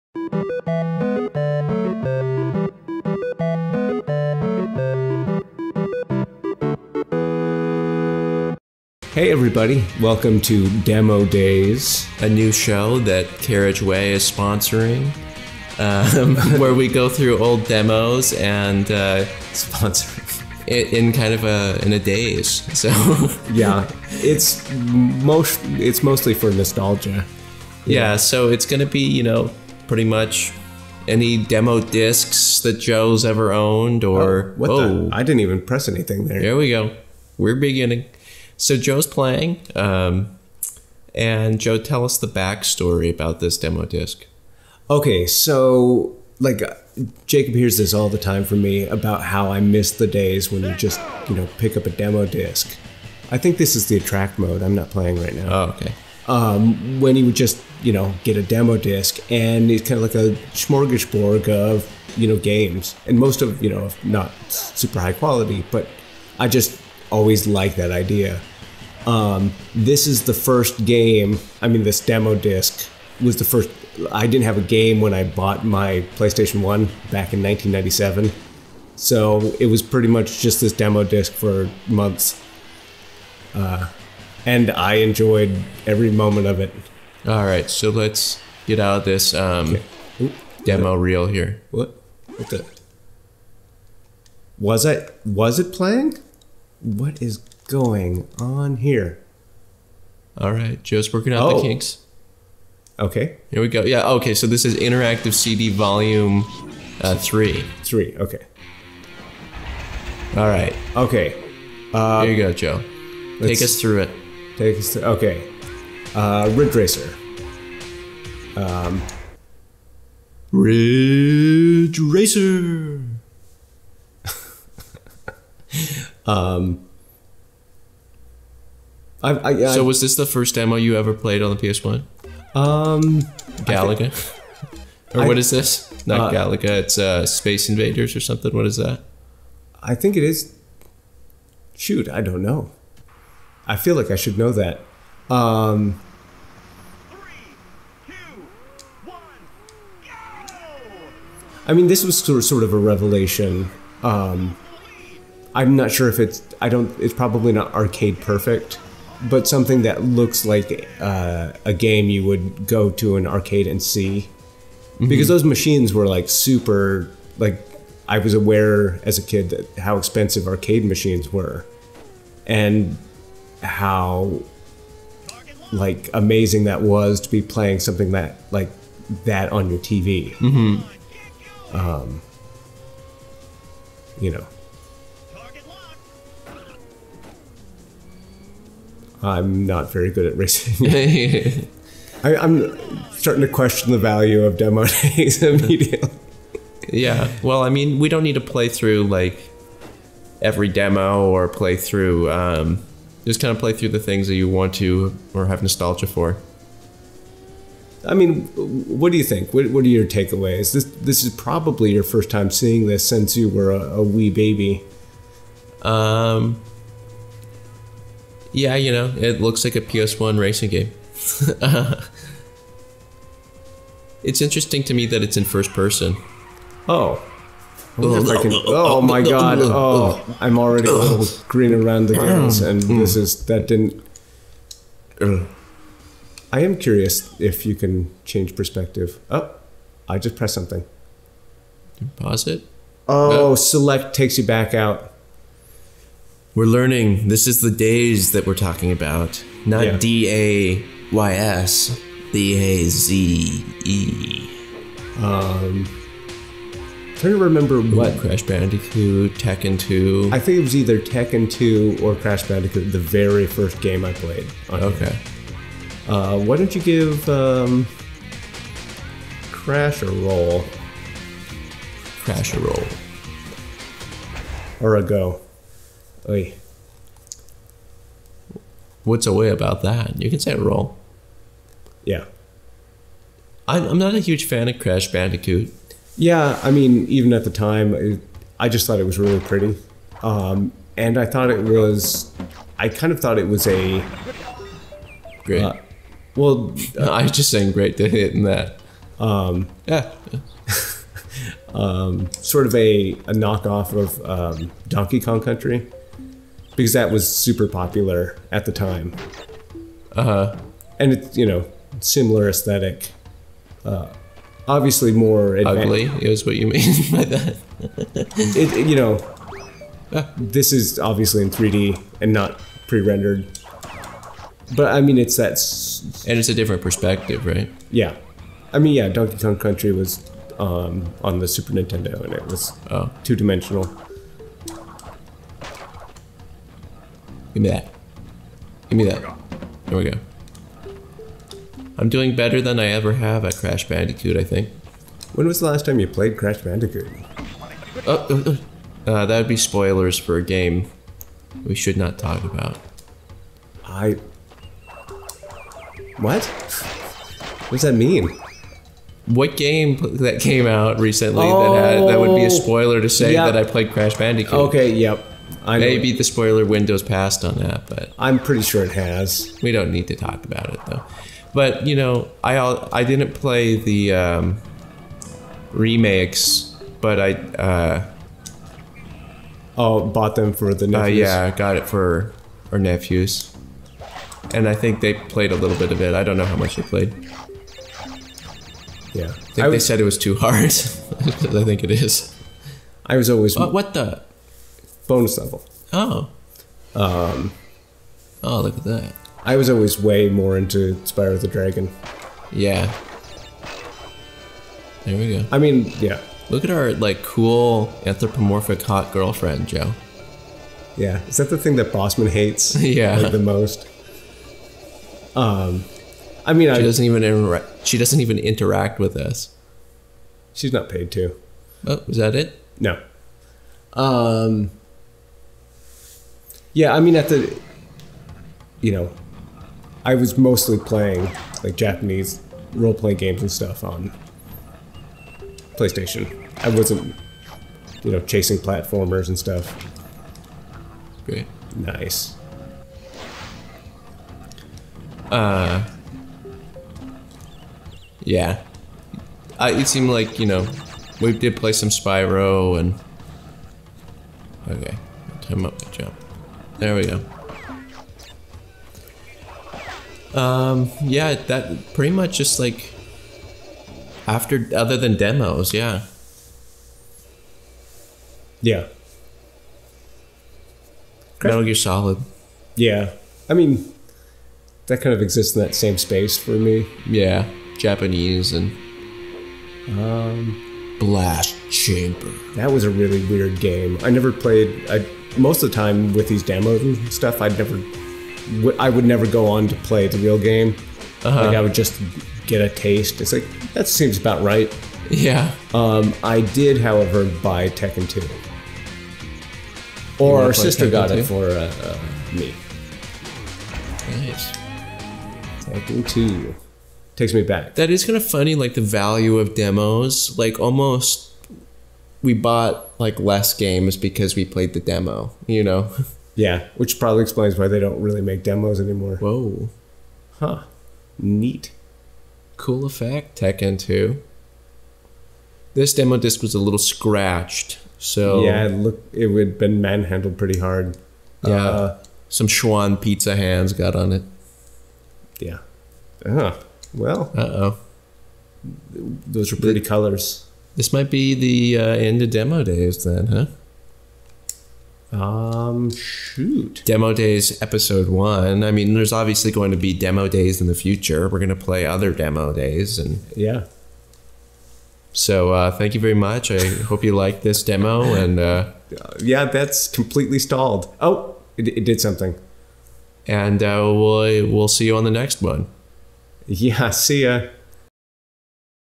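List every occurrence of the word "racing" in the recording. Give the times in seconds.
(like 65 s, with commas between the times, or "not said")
190 s, 220 s.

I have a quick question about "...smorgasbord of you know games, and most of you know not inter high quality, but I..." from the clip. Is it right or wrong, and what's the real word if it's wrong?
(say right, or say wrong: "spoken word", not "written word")
wrong: "super", not "inter".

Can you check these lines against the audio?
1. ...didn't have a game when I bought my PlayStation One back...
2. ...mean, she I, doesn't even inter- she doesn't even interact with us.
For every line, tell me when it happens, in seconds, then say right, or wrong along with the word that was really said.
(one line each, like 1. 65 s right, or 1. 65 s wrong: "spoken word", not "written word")
1. 74 s right
2. 416 s right.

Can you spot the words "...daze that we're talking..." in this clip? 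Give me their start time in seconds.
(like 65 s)
247 s.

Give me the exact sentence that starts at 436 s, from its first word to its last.
I wasn't, you know, chasing platformers and stuff.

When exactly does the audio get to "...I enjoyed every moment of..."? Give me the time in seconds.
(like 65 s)
84 s.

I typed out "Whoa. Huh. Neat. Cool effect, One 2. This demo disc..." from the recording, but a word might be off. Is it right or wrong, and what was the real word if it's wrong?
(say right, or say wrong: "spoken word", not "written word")
wrong: "Tekken", not "One".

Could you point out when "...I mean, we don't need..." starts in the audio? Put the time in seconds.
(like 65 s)
197 s.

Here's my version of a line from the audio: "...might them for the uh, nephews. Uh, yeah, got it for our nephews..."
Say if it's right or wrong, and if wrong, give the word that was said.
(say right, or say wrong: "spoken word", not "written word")
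wrong: "bought", not "might".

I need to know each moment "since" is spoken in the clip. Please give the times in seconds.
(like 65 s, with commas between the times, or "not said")
213 s.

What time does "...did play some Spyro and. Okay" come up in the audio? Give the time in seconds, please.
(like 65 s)
451 s.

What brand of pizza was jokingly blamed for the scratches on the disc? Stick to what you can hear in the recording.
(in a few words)
Schwan.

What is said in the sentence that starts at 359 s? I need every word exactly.
What game that came out recently oh, that had, that would be a spoiler to say yep.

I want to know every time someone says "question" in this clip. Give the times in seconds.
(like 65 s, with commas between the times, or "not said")
193 s.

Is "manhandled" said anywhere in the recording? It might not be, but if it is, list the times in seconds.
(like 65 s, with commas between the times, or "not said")
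529 s.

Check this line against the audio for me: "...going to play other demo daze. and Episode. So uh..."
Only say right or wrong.
wrong.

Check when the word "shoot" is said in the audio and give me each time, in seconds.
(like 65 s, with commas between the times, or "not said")
141 s, 545 s.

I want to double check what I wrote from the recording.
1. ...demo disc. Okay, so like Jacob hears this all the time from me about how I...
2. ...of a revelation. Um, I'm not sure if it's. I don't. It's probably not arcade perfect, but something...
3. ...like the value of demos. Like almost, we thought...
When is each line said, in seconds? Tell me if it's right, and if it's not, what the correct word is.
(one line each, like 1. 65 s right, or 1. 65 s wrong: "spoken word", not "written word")
1. 43 s right
2. 152 s right
3. 508 s wrong: "bought", not "thought".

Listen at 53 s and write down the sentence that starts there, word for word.
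I think this is the attract mode.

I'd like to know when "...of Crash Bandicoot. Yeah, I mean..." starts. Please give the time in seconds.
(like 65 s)
284 s.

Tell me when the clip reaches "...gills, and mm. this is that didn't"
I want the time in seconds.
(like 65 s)
232 s.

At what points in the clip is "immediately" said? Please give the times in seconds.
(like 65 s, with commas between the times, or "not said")
195 s.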